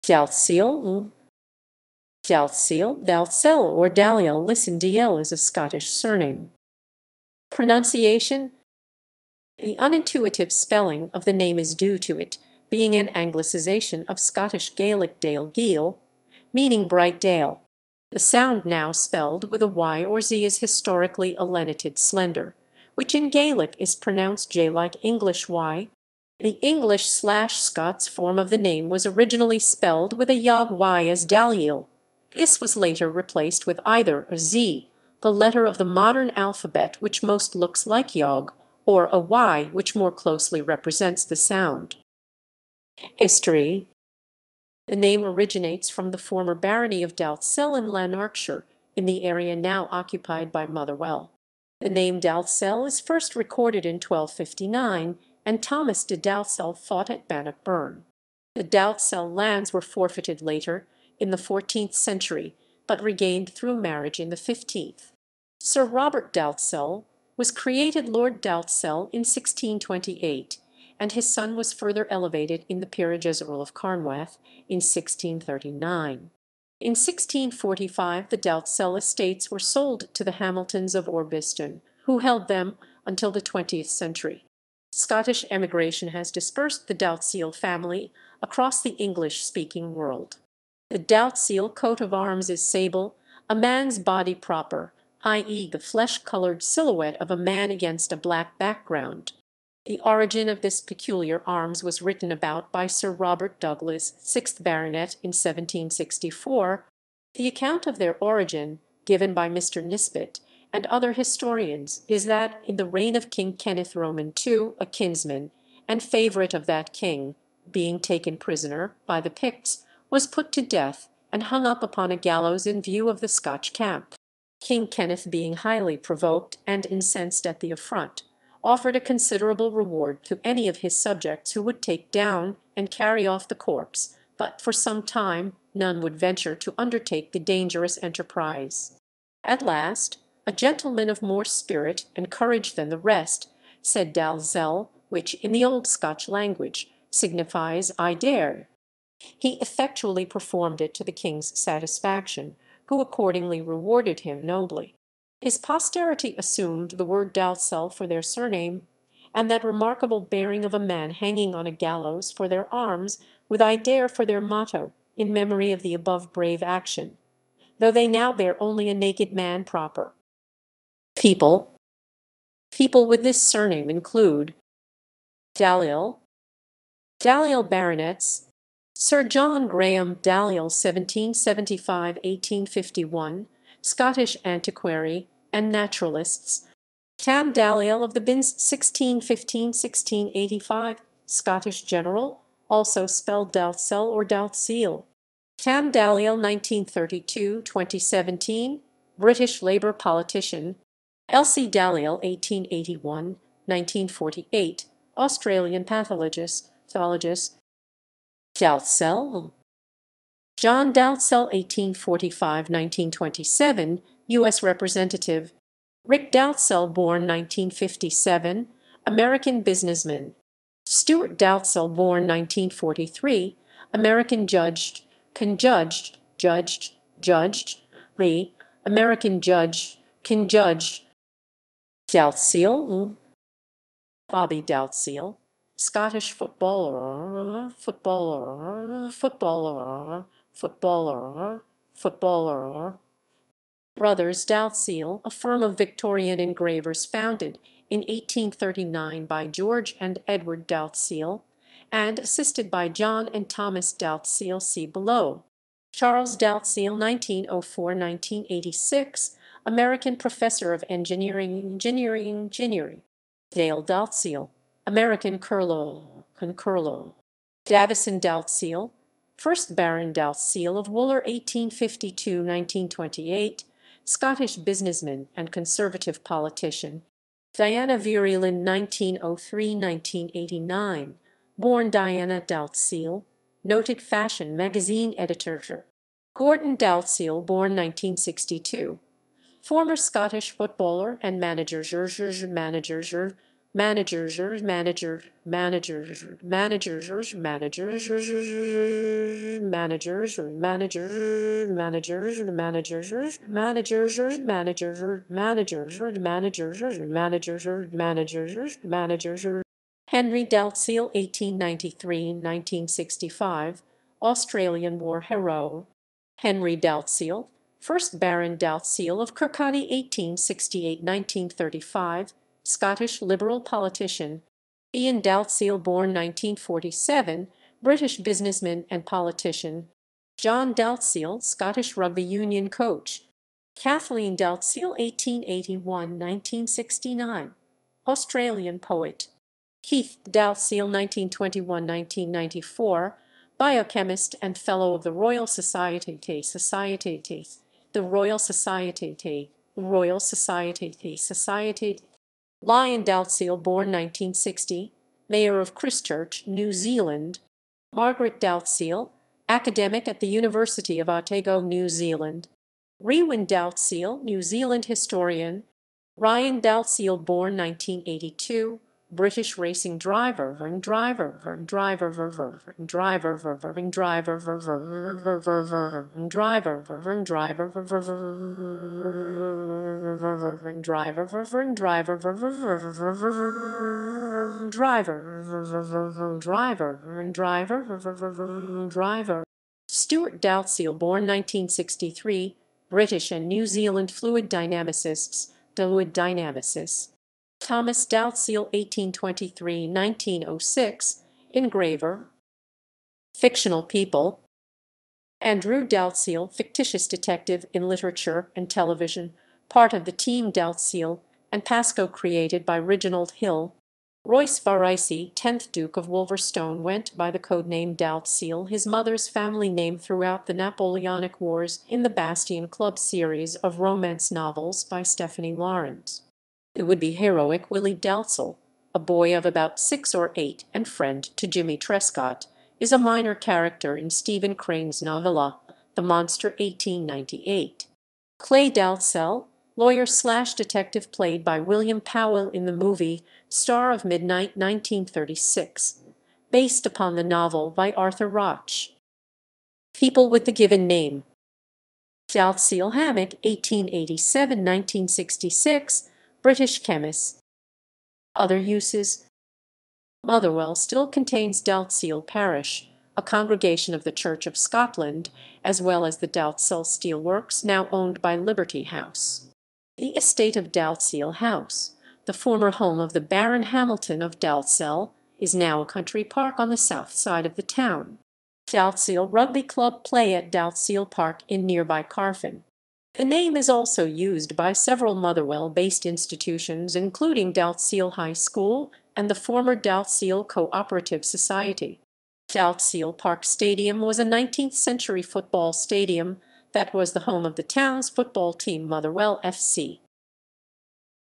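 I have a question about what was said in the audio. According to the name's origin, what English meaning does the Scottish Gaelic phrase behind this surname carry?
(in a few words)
bright dale.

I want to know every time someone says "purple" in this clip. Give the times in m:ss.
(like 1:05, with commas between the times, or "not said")
not said.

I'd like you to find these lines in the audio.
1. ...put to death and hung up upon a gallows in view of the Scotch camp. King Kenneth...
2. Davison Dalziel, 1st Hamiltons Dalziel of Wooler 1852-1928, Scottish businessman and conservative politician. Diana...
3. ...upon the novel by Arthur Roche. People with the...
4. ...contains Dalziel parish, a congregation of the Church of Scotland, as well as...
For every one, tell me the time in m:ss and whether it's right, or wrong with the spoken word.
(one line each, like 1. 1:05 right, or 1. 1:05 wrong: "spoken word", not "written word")
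1. 2:00 right
2. 4:27 wrong: "Baron", not "Hamiltons"
3. 7:26 right
4. 7:41 right.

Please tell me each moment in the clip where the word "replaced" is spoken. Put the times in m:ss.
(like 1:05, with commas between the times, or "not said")
0:33.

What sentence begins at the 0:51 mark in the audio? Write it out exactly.
The name Dalzell is first recorded in 1259 and Thomas de Dalzell fought at Bannockburn.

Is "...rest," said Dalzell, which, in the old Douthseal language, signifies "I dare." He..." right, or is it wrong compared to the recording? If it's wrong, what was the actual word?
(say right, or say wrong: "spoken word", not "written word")
wrong: "Scotch", not "Douthseal".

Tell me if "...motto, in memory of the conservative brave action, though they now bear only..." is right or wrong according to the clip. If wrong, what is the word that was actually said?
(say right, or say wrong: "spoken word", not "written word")
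wrong: "above", not "conservative".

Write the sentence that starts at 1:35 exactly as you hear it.
the flesh-colored silhouette of a man against a black background.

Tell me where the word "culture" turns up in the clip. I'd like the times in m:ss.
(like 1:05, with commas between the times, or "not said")
not said.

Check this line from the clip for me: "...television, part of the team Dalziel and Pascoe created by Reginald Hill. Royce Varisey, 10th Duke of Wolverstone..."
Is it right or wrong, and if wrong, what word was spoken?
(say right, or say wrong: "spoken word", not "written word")
right.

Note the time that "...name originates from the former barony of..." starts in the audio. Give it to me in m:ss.
0:44.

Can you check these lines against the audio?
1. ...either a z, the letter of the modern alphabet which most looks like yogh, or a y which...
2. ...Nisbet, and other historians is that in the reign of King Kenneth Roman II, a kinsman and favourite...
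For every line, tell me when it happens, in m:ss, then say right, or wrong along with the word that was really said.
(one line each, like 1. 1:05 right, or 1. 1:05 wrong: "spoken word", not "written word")
1. 0:33 right
2. 1:49 right.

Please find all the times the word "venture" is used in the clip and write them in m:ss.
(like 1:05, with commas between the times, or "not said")
2:16.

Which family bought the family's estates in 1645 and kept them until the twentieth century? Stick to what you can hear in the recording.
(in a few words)
Hamiltons of Orbiston.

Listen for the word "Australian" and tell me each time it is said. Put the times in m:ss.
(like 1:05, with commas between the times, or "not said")
3:25, 5:14, 5:38.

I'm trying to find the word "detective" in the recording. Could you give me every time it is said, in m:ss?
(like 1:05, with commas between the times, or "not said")
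6:47, 7:20.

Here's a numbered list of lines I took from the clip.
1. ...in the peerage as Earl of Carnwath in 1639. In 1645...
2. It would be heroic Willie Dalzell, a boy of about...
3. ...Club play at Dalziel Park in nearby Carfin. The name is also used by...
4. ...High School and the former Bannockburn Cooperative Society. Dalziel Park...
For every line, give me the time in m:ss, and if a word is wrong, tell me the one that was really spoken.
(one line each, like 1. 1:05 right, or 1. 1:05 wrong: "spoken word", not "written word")
1. 1:12 right
2. 7:06 right
3. 7:59 right
4. 8:08 wrong: "Dalziel", not "Bannockburn".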